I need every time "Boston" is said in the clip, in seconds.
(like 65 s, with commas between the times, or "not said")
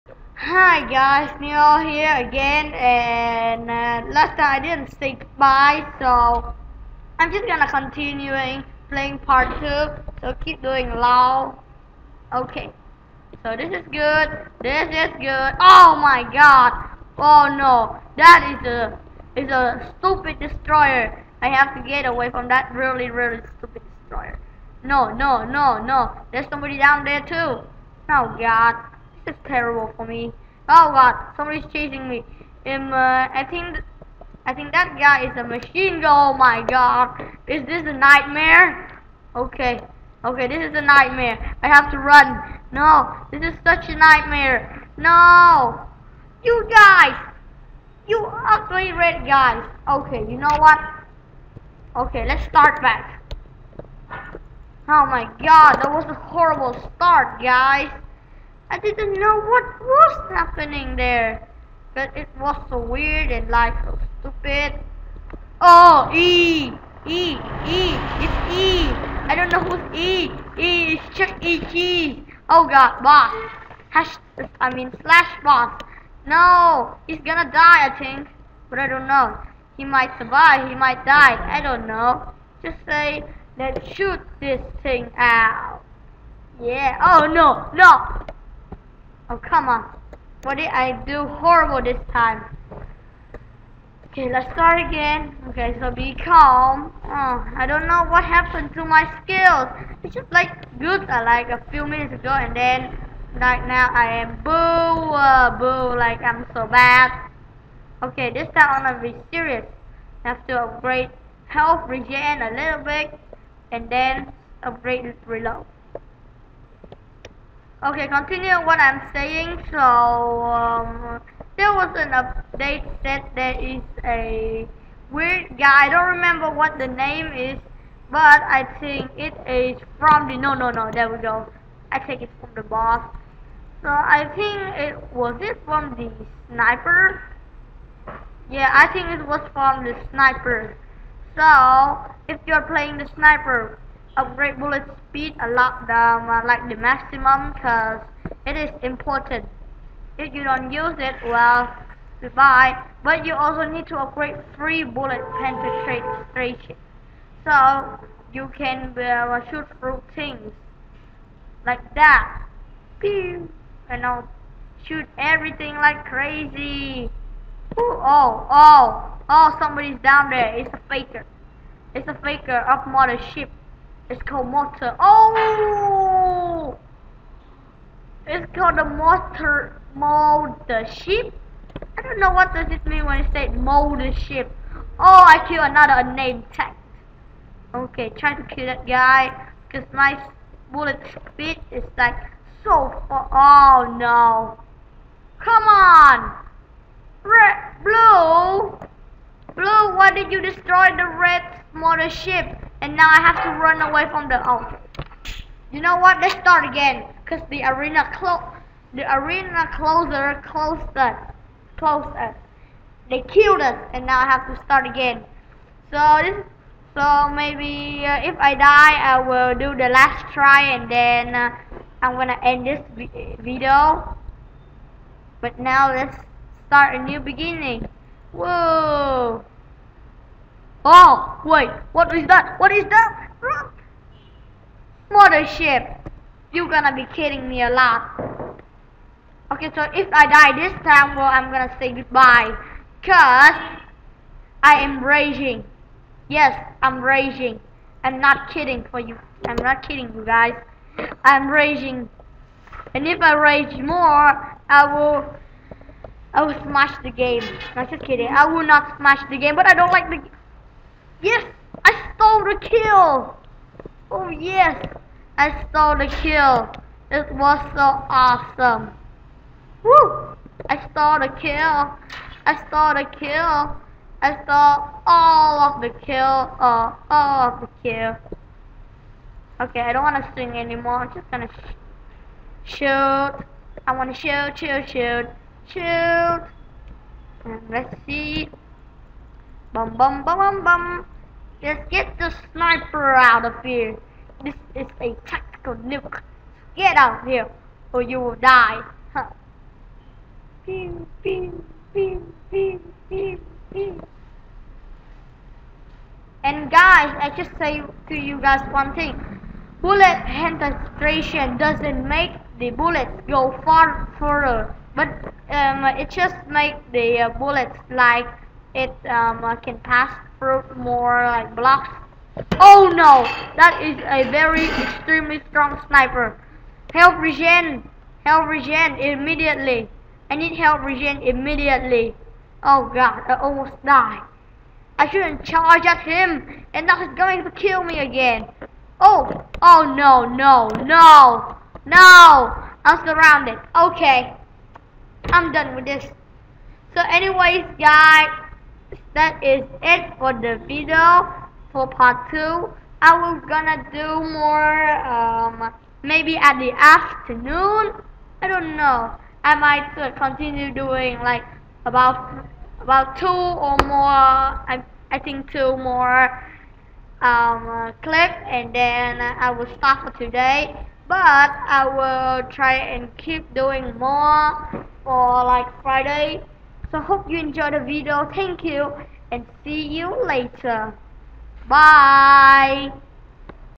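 not said.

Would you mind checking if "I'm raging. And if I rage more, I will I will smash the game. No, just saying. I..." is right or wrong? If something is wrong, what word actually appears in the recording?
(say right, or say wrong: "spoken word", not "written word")
wrong: "kidding", not "saying".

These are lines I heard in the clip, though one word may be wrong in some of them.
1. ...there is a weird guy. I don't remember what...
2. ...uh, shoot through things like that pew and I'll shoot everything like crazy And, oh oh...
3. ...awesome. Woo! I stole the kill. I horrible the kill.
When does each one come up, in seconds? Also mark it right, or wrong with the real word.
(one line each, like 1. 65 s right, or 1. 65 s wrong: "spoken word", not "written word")
1. 123 s right
2. 158 s wrong: "Ooh", not "And"
3. 268 s wrong: "stole", not "horrible".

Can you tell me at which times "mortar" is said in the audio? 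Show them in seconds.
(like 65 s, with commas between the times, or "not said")
174 s, 178 s.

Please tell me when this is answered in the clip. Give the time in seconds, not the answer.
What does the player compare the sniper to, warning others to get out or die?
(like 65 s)
295 s.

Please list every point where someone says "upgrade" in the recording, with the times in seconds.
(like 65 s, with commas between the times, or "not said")
110 s, 114 s, 144 s, 153 s.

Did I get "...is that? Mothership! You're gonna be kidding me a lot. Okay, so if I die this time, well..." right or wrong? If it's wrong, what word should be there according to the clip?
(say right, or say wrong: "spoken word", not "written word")
right.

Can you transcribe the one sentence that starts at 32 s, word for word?
Um, uh, I think, I think that guy is a machine gun.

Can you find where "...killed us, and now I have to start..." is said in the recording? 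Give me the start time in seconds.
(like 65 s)
213 s.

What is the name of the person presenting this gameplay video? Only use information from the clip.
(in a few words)
Neil.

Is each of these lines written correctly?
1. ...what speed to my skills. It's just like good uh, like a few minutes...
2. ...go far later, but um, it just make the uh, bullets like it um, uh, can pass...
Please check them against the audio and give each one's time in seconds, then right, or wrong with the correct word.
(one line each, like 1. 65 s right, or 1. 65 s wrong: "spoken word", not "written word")
1. 98 s wrong: "happened", not "speed"
2. 313 s wrong: "further", not "later".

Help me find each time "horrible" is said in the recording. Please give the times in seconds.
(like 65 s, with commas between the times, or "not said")
56 s, 91 s.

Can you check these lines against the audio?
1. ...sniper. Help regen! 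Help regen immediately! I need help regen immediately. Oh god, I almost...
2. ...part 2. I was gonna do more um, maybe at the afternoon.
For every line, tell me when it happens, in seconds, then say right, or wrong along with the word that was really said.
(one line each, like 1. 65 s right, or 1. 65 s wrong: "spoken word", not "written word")
1. 325 s right
2. 351 s right.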